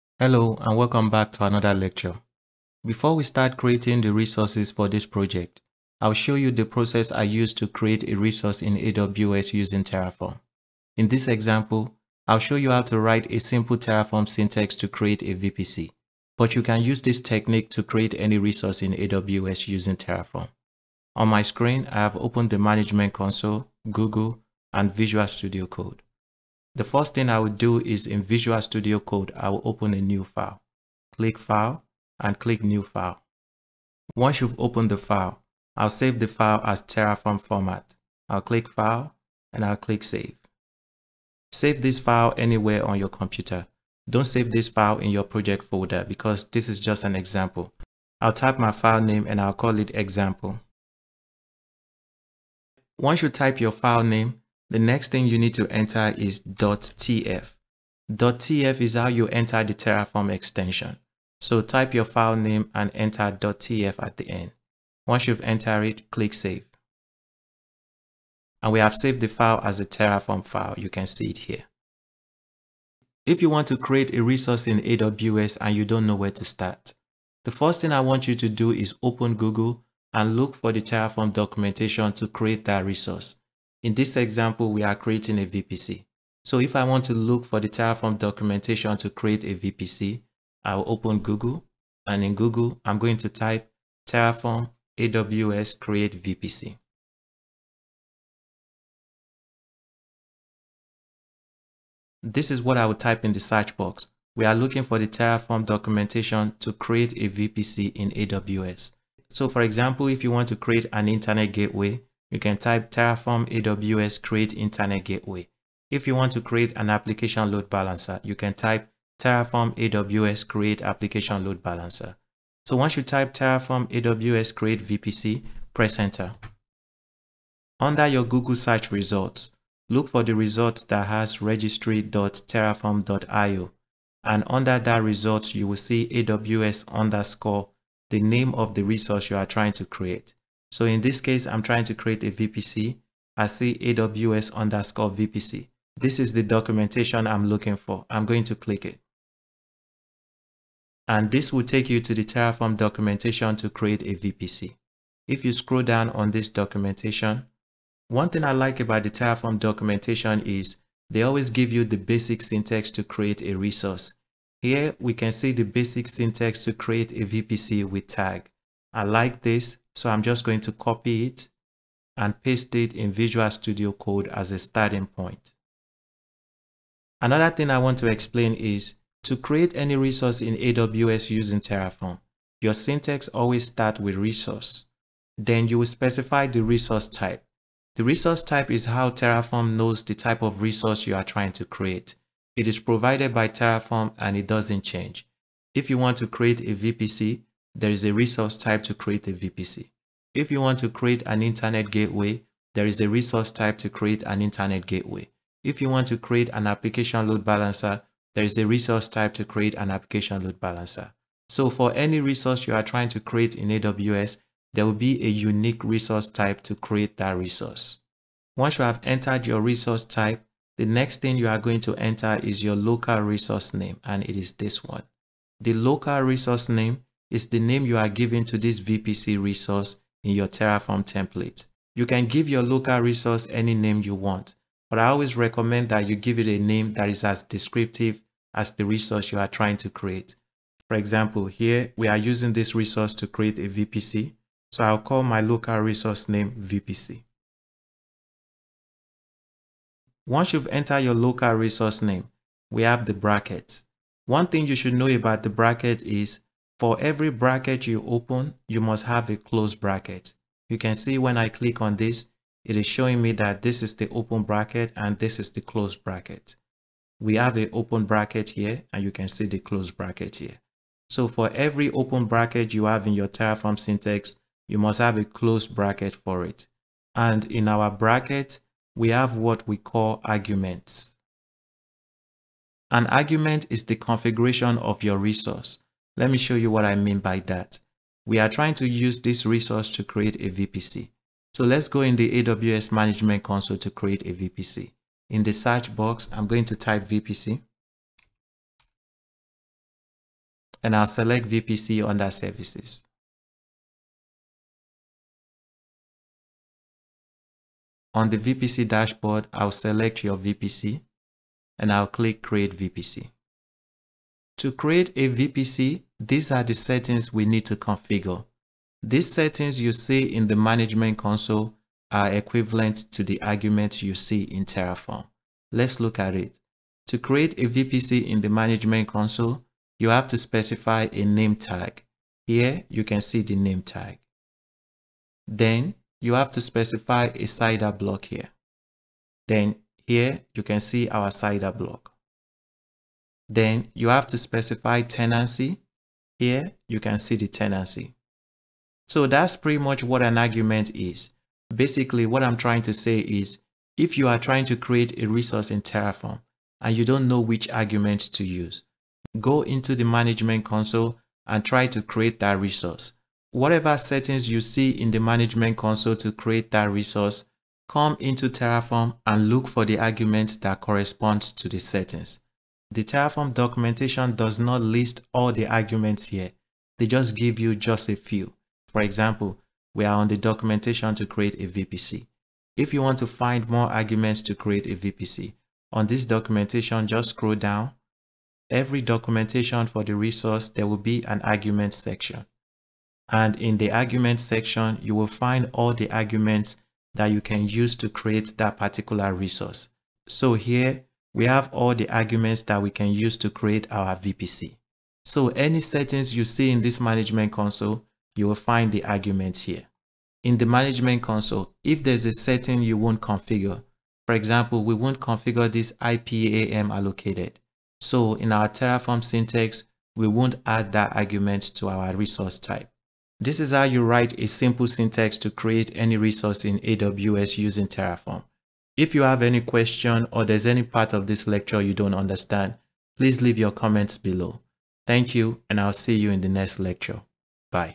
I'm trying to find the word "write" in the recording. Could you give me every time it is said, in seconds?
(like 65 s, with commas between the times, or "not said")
12 s, 424 s.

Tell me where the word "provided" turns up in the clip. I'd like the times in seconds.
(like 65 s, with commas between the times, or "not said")
192 s.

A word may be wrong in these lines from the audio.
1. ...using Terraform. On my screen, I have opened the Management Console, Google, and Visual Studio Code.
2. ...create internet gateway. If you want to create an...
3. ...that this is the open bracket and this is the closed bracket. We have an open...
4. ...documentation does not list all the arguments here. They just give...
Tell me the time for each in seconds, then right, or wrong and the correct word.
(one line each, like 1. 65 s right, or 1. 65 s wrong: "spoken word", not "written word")
1. 19 s right
2. 114 s right
3. 263 s right
4. 373 s right.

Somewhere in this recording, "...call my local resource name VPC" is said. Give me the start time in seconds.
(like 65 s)
244 s.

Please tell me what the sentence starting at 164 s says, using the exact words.
Here we can see the basic syntax to create a VPC with tag.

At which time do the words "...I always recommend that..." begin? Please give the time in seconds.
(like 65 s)
234 s.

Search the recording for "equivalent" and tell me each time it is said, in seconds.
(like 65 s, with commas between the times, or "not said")
322 s.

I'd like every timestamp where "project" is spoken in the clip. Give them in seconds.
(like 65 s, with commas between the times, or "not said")
5 s, 45 s.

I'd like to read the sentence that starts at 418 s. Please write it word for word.
So in our Terraform syntax, we won't add that argument to our resource type.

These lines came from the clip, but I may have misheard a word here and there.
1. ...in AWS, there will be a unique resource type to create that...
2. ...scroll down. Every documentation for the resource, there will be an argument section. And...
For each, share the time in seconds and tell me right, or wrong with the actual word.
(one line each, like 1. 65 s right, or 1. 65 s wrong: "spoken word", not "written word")
1. 213 s right
2. 387 s right.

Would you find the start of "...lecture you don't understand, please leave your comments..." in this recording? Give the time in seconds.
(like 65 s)
431 s.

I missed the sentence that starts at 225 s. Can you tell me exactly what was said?
The local resource name is the name you are giving to this VPC resource in your Terraform template.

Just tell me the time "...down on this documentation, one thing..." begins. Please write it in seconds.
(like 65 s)
155 s.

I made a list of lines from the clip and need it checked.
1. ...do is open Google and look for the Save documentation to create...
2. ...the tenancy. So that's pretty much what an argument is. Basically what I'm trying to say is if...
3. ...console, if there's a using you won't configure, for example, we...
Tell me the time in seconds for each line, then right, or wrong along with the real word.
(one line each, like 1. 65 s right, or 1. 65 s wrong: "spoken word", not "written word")
1. 78 s wrong: "Terraform", not "Save"
2. 347 s right
3. 411 s wrong: "setting", not "using".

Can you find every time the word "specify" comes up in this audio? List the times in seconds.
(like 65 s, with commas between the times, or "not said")
185 s, 330 s, 336 s, 344 s.